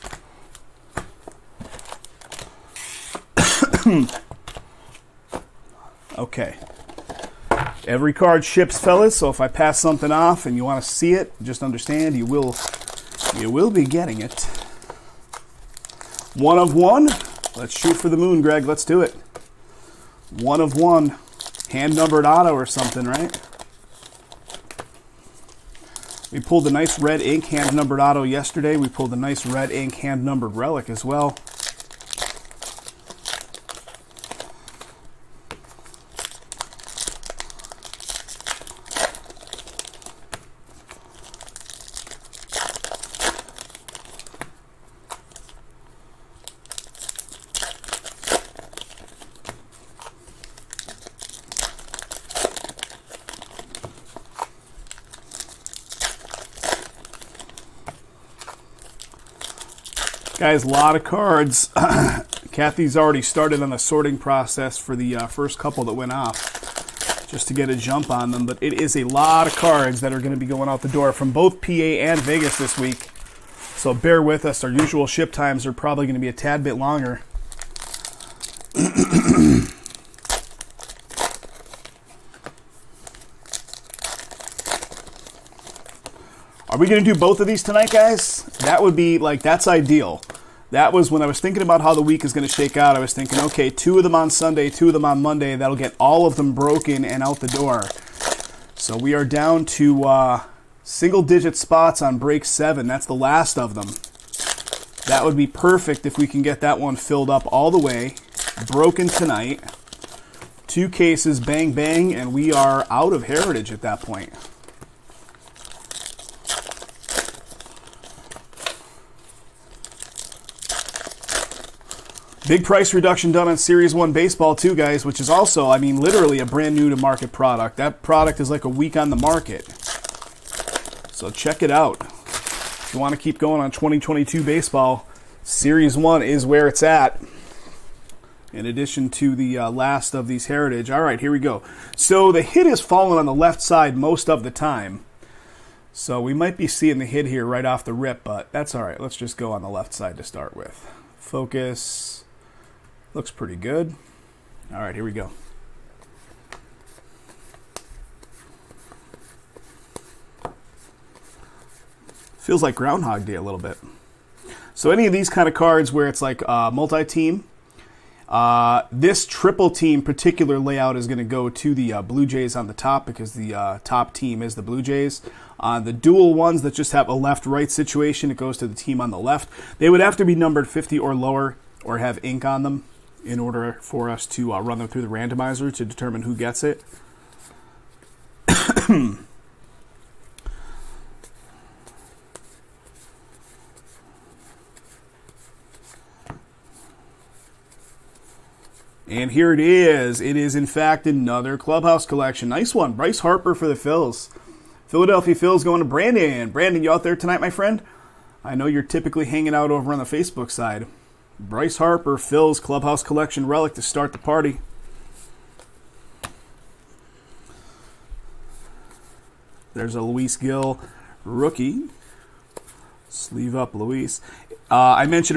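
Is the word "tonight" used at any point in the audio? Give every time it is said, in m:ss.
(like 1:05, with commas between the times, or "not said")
1:27, 1:49, 3:27.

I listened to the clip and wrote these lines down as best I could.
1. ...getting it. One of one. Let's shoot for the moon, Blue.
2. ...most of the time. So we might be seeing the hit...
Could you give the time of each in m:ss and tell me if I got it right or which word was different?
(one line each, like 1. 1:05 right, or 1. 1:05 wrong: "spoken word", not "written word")
1. 0:13 wrong: "Greg", not "Blue"
2. 2:23 right.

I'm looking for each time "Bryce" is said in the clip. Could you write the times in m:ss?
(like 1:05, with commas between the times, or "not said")
3:22, 3:31.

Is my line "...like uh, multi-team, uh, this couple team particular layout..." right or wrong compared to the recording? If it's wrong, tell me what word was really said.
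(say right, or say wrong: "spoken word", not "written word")
wrong: "triple", not "couple".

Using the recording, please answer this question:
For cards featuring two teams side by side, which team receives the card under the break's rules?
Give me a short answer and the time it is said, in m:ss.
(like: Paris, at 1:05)
the team on the left, at 2:58.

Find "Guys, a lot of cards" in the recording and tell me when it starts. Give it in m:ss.
1:00.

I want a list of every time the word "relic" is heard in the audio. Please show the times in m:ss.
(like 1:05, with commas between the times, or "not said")
0:30, 3:33.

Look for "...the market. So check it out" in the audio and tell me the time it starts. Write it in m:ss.
2:09.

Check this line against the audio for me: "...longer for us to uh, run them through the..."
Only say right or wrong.
wrong.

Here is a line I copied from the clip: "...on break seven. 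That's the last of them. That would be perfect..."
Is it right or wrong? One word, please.
right.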